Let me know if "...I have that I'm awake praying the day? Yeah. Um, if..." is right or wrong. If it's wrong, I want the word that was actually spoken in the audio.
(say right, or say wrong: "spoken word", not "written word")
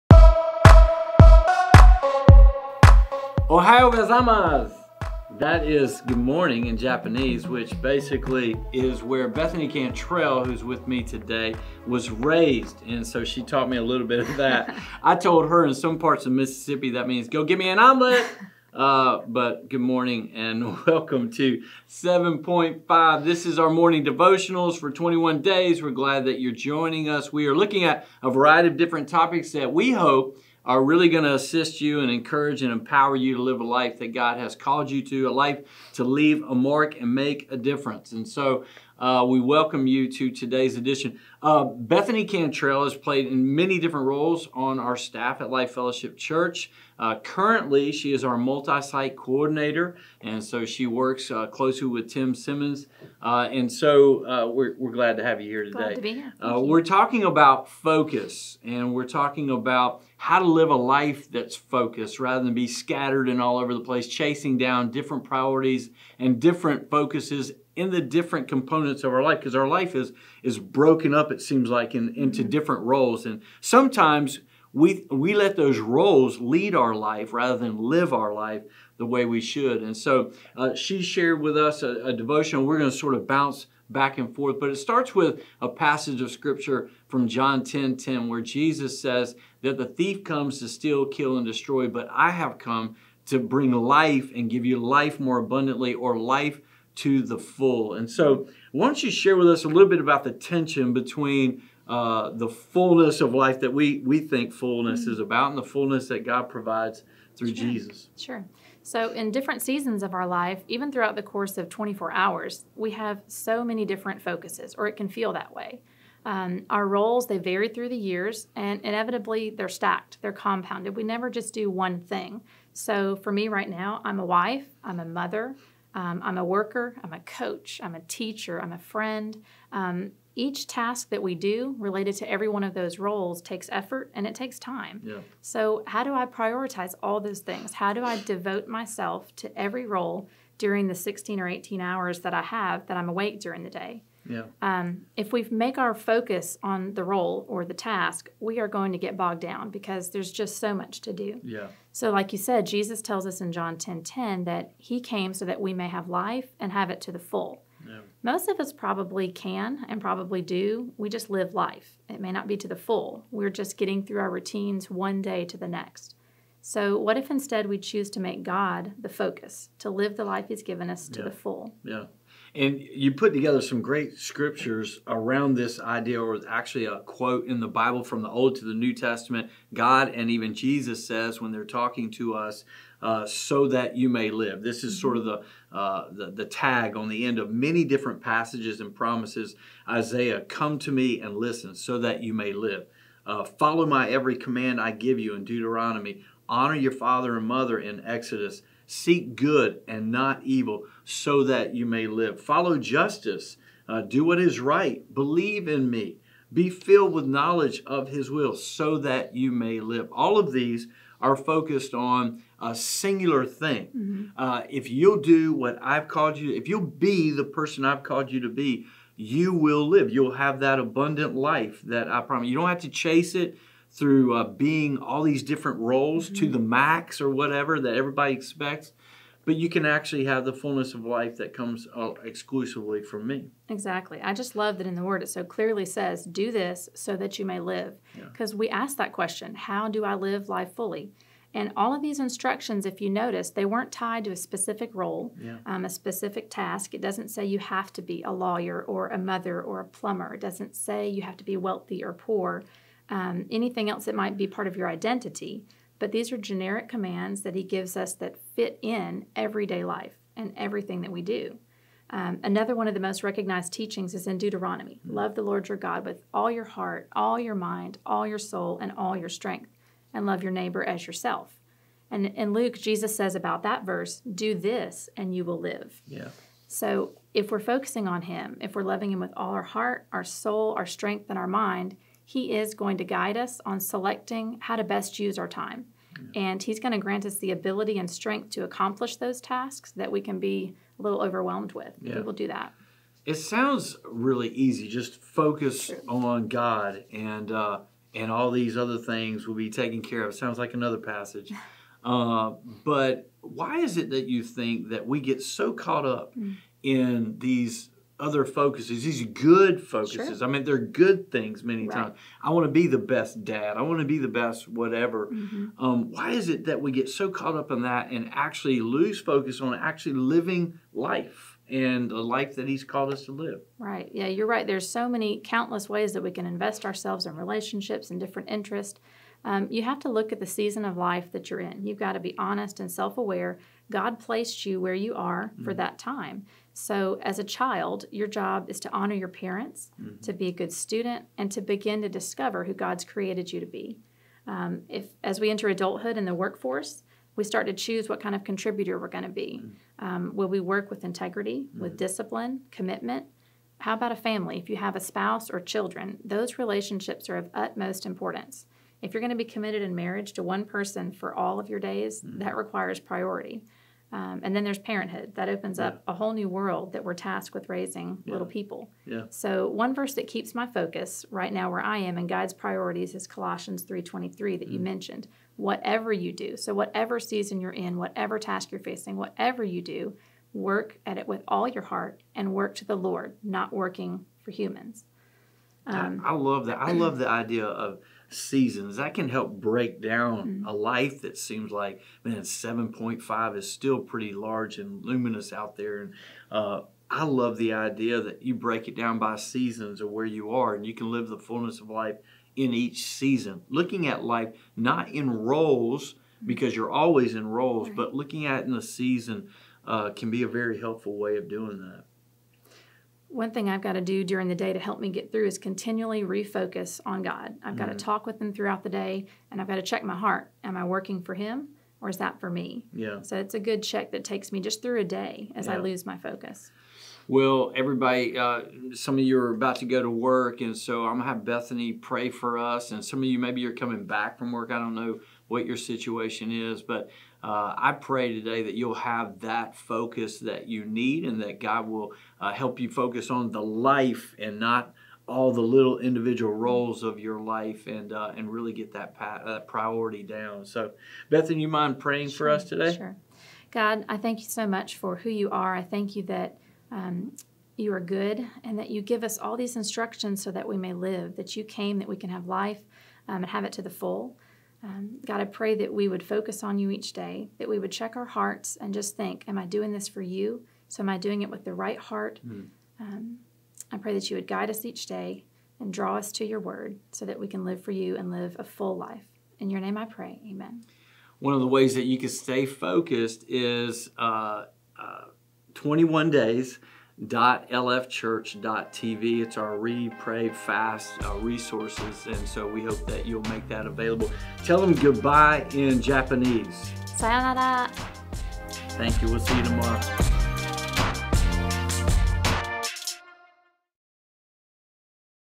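wrong: "during", not "praying".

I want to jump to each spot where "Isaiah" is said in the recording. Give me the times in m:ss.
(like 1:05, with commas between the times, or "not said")
3:09.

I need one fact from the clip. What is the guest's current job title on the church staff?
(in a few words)
Multi site coordinator.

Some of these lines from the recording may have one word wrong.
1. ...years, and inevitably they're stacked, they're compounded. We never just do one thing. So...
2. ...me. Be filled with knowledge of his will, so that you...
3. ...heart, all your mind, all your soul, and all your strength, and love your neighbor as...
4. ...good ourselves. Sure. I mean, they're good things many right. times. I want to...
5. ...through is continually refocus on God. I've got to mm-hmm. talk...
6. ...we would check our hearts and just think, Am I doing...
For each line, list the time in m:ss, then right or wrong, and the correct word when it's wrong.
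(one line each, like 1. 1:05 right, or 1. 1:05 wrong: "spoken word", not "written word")
1. 1:57 right
2. 3:25 right
3. 4:26 right
4. 5:09 wrong: "focuses", not "ourselves"
5. 6:55 right
6. 7:47 right.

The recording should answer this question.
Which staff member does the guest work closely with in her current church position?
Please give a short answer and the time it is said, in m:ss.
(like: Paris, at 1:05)
Tim Simmons, at 0:52.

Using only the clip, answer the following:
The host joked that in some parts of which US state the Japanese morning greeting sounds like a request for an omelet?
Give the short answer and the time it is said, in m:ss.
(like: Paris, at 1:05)
Mississippi, at 0:16.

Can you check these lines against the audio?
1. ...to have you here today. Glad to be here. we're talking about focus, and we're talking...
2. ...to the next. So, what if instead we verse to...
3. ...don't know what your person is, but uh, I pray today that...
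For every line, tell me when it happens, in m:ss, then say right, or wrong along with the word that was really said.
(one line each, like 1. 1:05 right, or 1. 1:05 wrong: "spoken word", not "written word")
1. 0:55 right
2. 2:45 wrong: "choose", not "verse"
3. 7:14 wrong: "situation", not "person".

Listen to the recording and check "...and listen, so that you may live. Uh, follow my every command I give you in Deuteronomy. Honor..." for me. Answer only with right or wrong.
right.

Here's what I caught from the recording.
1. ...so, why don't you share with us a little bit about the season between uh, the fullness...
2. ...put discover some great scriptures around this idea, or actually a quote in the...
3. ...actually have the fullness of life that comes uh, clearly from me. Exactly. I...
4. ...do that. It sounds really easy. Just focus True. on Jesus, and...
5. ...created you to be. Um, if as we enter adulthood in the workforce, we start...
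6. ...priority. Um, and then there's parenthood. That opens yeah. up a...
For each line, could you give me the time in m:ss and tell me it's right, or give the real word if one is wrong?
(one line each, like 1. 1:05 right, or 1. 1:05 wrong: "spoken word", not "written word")
1. 1:38 wrong: "tension", not "season"
2. 2:53 wrong: "together", not "discover"
3. 3:49 wrong: "exclusively", not "clearly"
4. 4:52 wrong: "God", not "Jesus"
5. 5:43 right
6. 6:02 right.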